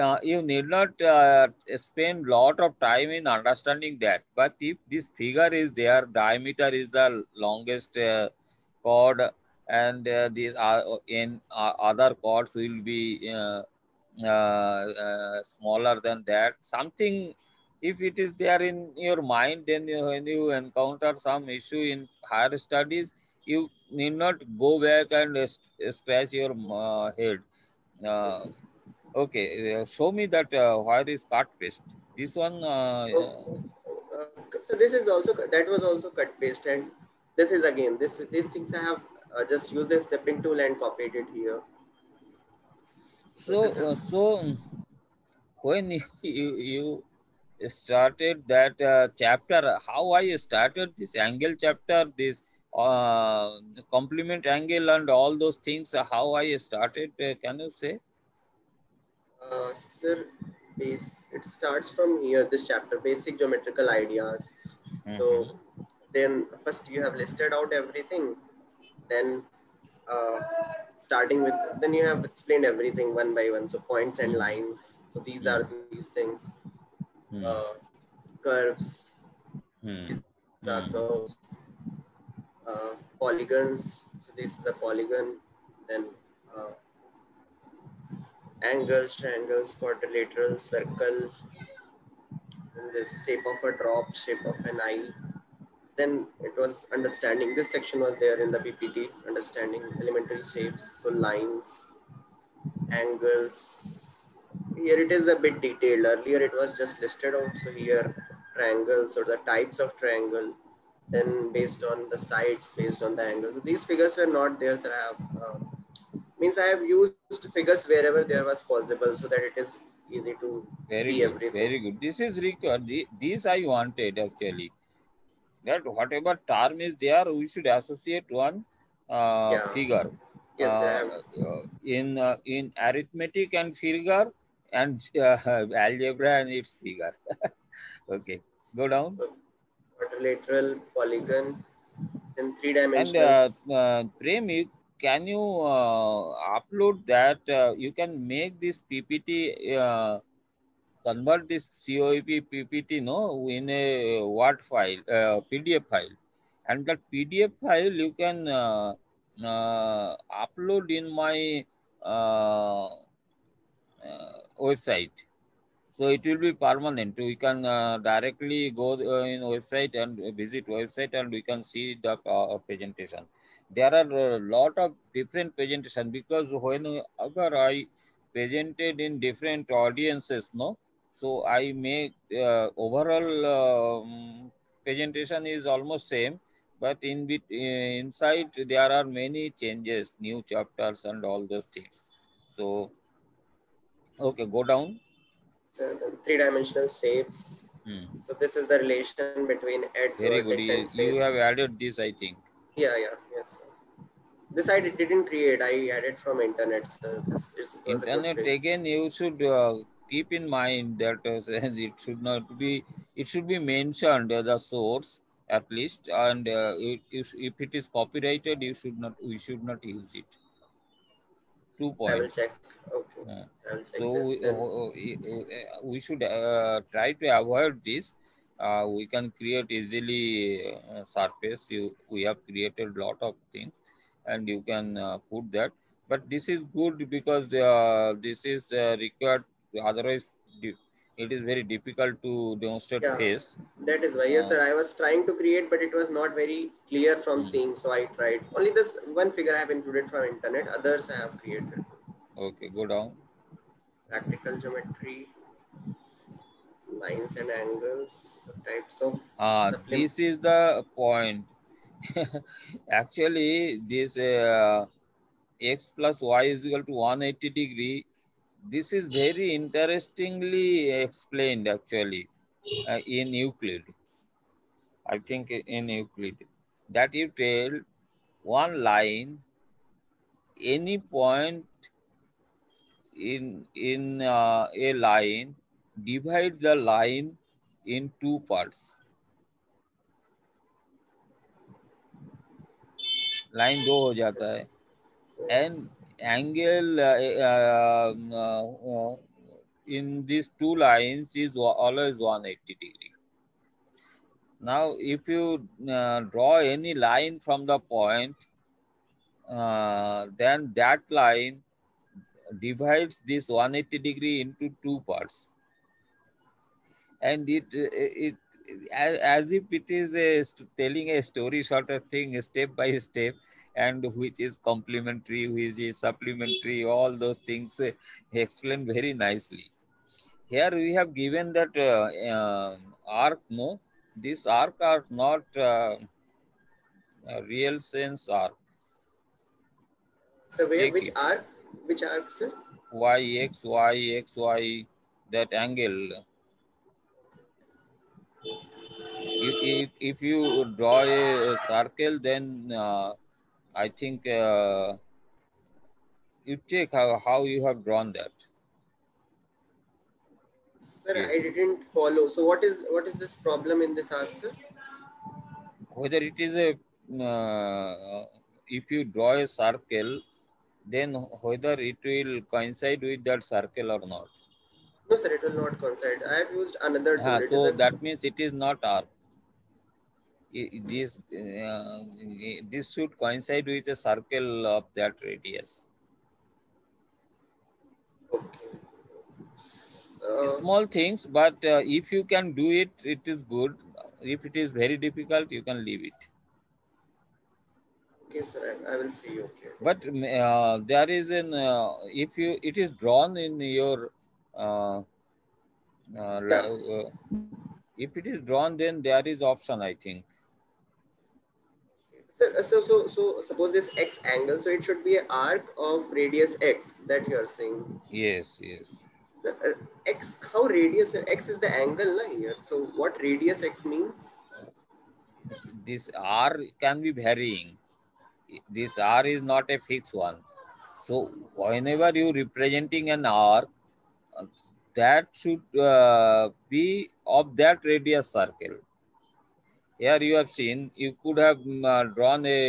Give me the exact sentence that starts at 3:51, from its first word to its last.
You, we have created lot of things and you can uh, put that.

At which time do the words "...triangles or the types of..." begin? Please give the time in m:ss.
1:48.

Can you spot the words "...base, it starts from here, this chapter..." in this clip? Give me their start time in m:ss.
1:00.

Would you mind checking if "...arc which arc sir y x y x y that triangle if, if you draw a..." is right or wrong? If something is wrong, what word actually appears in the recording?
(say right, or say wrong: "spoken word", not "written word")
wrong: "angle", not "triangle".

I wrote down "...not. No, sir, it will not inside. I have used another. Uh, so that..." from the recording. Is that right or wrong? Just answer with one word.
wrong.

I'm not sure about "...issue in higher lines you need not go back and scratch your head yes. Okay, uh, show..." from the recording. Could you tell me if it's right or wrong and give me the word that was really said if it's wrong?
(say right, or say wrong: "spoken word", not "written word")
wrong: "studies", not "lines".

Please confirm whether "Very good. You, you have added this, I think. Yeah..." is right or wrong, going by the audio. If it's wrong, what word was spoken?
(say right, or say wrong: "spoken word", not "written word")
right.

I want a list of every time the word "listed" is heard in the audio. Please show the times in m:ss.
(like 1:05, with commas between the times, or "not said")
1:07, 1:46.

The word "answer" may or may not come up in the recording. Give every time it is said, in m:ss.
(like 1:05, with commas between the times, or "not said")
6:04.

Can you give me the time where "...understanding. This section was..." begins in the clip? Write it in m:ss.
1:36.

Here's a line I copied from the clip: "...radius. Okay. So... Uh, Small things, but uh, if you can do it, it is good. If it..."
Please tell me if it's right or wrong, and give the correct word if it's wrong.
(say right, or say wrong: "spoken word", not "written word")
right.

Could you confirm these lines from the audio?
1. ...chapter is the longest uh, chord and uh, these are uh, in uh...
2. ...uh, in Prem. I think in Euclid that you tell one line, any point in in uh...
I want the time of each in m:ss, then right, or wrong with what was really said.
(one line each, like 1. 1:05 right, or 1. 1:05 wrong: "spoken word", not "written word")
1. 0:06 wrong: "diameter", not "chapter"
2. 4:32 wrong: "Euclid", not "Prem".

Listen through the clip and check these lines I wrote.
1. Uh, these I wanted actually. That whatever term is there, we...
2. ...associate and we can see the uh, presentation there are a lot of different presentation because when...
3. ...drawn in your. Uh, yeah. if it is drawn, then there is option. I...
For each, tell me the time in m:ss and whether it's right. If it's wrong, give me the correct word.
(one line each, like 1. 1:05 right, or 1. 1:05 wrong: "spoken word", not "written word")
1. 2:02 right
2. 2:50 wrong: "website", not "associate"
3. 6:42 right.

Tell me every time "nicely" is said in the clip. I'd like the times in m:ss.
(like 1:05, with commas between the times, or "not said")
5:29.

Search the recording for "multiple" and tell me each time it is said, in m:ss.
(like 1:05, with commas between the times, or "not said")
not said.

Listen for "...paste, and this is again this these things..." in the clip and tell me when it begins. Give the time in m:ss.
0:36.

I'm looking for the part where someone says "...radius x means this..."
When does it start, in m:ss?
7:03.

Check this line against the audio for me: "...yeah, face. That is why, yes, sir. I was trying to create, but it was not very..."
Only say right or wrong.
right.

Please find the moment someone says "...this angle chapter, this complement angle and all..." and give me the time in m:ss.
0:50.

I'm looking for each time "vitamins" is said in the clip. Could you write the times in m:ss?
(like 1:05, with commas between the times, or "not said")
not said.